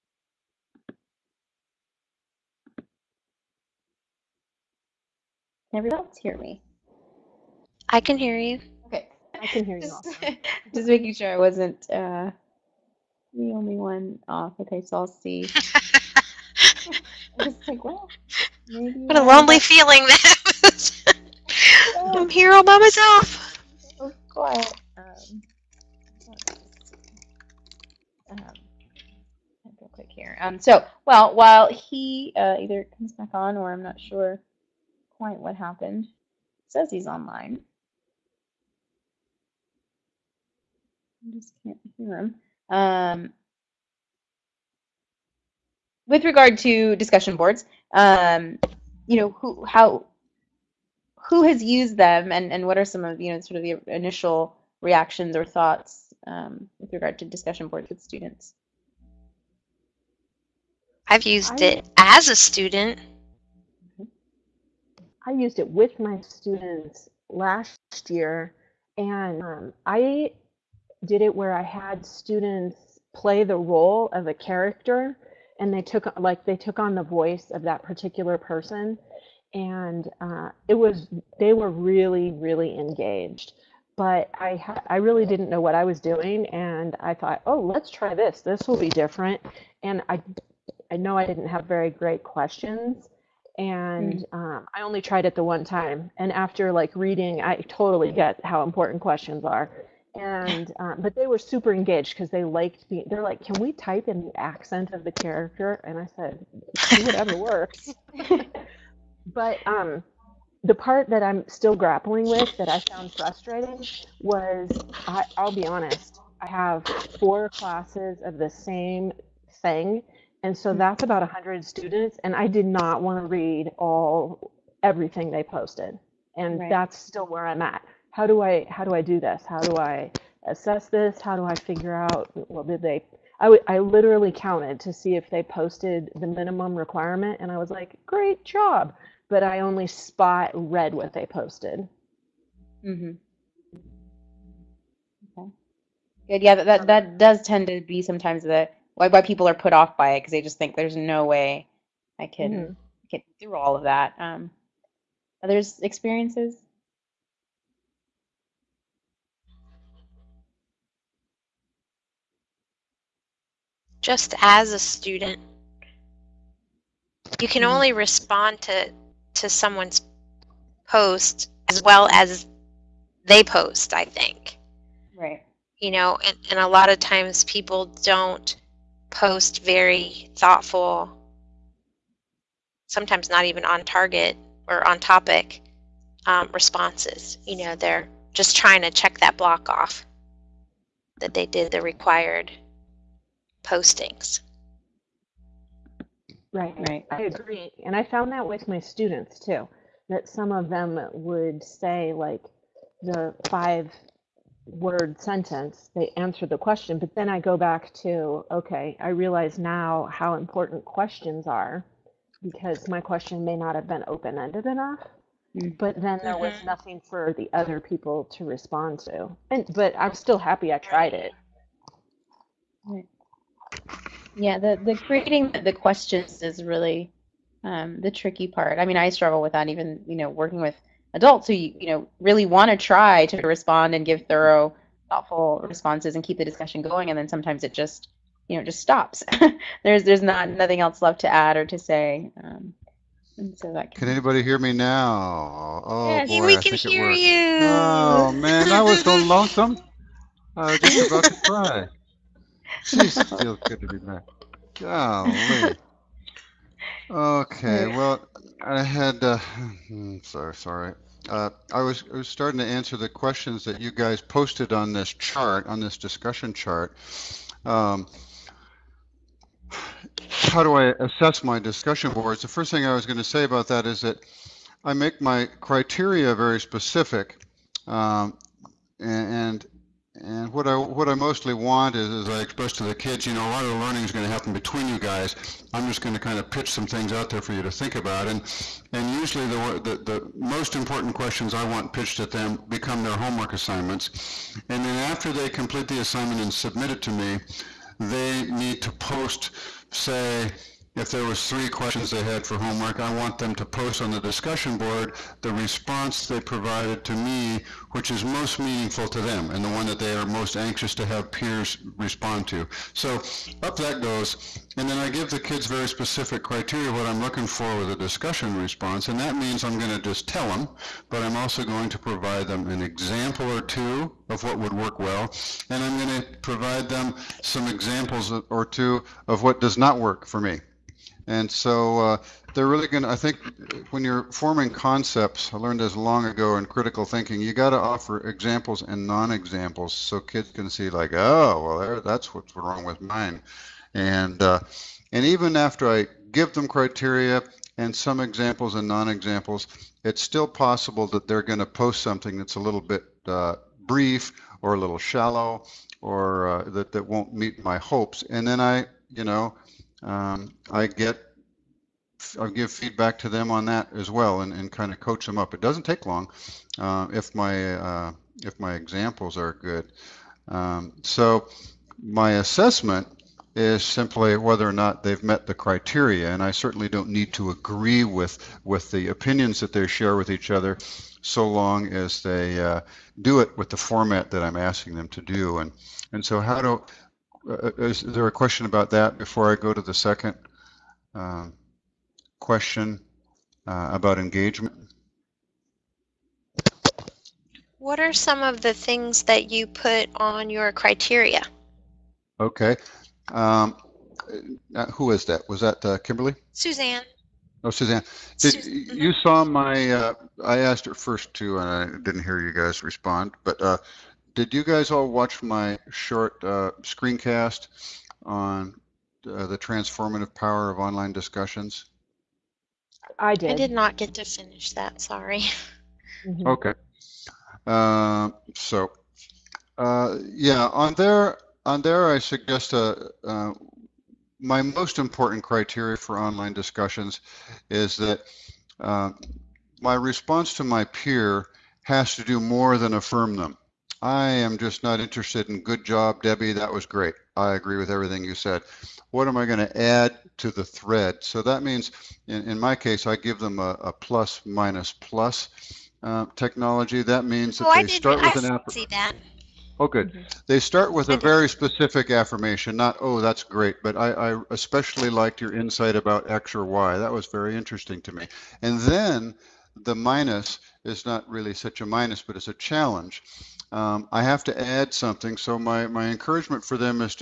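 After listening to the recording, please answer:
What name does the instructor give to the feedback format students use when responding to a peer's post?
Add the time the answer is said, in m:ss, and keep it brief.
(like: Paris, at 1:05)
plus minus plus, at 7:33.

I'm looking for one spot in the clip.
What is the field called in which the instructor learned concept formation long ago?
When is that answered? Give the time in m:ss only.
5:36.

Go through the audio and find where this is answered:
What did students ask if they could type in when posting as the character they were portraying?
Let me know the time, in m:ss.
1:44.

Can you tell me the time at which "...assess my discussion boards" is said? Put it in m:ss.
4:30.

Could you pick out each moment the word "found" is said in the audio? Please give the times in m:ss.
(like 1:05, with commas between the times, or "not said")
1:52, 3:18.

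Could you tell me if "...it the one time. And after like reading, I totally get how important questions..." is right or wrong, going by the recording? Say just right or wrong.
right.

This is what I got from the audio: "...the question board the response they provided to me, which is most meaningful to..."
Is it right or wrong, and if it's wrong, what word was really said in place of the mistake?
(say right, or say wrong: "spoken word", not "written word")
wrong: "discussion", not "question".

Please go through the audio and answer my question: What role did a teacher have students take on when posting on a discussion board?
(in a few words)
a character.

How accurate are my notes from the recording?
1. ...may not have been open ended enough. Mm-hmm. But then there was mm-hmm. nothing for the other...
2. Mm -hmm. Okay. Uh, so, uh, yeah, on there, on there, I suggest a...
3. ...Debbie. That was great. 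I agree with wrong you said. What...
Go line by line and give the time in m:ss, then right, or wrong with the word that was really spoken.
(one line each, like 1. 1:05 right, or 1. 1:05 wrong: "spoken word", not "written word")
1. 3:33 right
2. 7:06 right
3. 7:26 wrong: "everything", not "wrong".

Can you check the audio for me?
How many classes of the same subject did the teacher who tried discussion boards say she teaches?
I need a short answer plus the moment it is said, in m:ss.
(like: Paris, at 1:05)
4, at 1:57.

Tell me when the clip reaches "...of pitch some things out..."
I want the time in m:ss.
4:46.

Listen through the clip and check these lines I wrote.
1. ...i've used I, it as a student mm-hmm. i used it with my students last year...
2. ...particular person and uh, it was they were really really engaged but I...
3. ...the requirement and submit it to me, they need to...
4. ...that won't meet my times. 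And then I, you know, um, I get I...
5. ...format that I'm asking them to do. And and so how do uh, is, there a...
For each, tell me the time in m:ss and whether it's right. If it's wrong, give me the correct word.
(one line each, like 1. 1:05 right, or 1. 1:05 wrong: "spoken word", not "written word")
1. 1:01 right
2. 1:17 right
3. 4:55 wrong: "assignment", not "requirement"
4. 5:56 wrong: "hopes", not "times"
5. 6:23 right.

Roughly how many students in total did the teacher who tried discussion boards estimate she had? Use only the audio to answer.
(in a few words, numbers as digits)
100.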